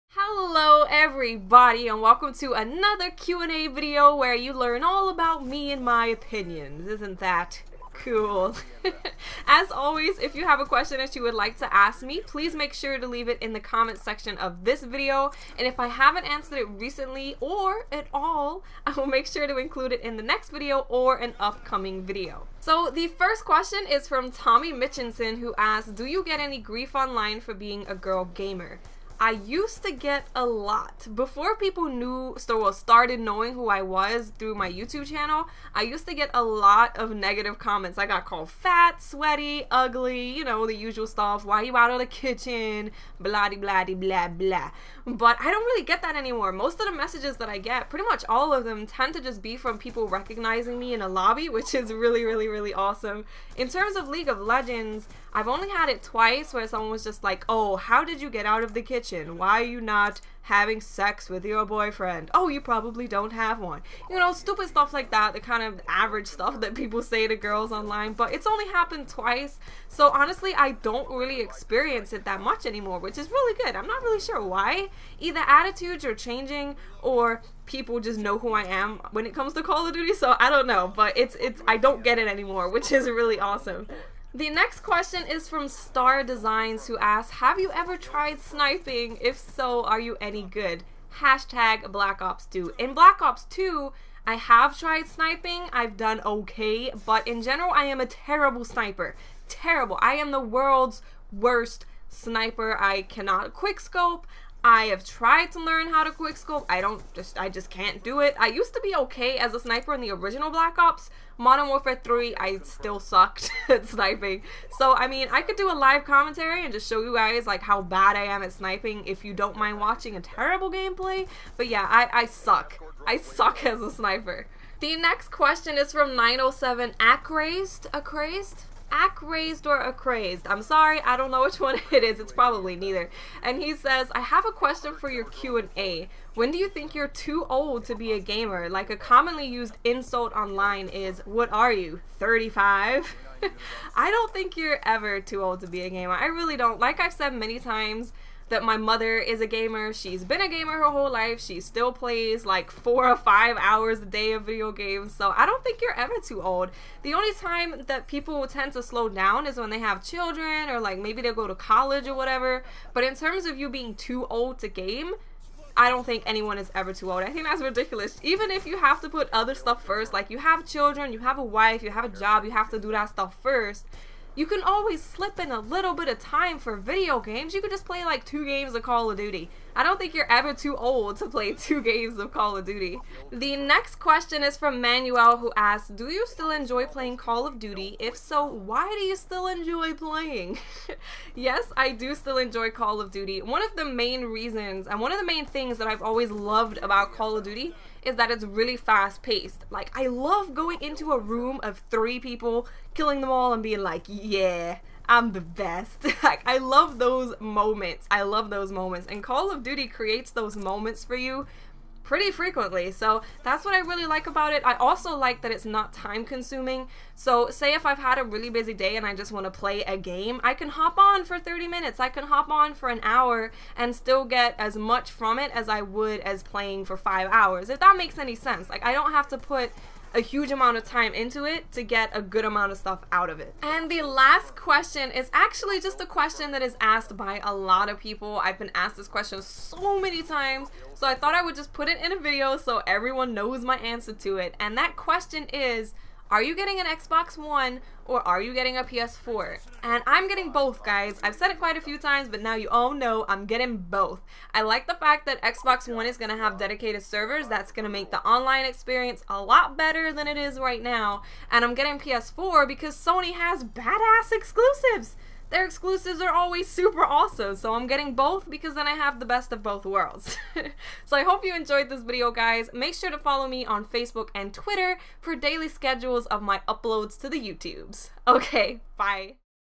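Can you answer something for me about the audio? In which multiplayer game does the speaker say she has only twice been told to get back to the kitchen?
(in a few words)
League of Legends.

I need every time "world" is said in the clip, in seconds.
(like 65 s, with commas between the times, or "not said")
100 s, 269 s.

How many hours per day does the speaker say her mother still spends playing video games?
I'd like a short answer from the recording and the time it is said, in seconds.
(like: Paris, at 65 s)
4 or 5, at 152 s.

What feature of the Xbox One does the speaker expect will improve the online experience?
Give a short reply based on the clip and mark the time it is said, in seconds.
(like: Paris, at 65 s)
Dedicated servers, at 256 s.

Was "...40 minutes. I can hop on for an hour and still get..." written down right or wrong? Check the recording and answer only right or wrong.
wrong.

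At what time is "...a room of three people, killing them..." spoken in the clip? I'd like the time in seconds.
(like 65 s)
201 s.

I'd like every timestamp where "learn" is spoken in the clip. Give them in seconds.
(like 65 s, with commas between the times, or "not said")
4 s, 105 s.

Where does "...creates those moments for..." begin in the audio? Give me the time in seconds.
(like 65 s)
209 s.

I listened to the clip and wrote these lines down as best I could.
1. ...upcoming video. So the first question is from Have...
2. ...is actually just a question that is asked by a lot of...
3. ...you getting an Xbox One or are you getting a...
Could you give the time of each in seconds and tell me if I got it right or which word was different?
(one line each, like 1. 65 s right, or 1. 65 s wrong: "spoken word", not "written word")
1. 21 s wrong: "Tommy", not "Have"
2. 235 s right
3. 246 s right.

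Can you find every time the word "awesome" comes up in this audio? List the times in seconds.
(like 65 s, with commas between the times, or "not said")
52 s, 83 s, 267 s.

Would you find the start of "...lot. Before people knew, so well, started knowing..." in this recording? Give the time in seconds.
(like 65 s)
30 s.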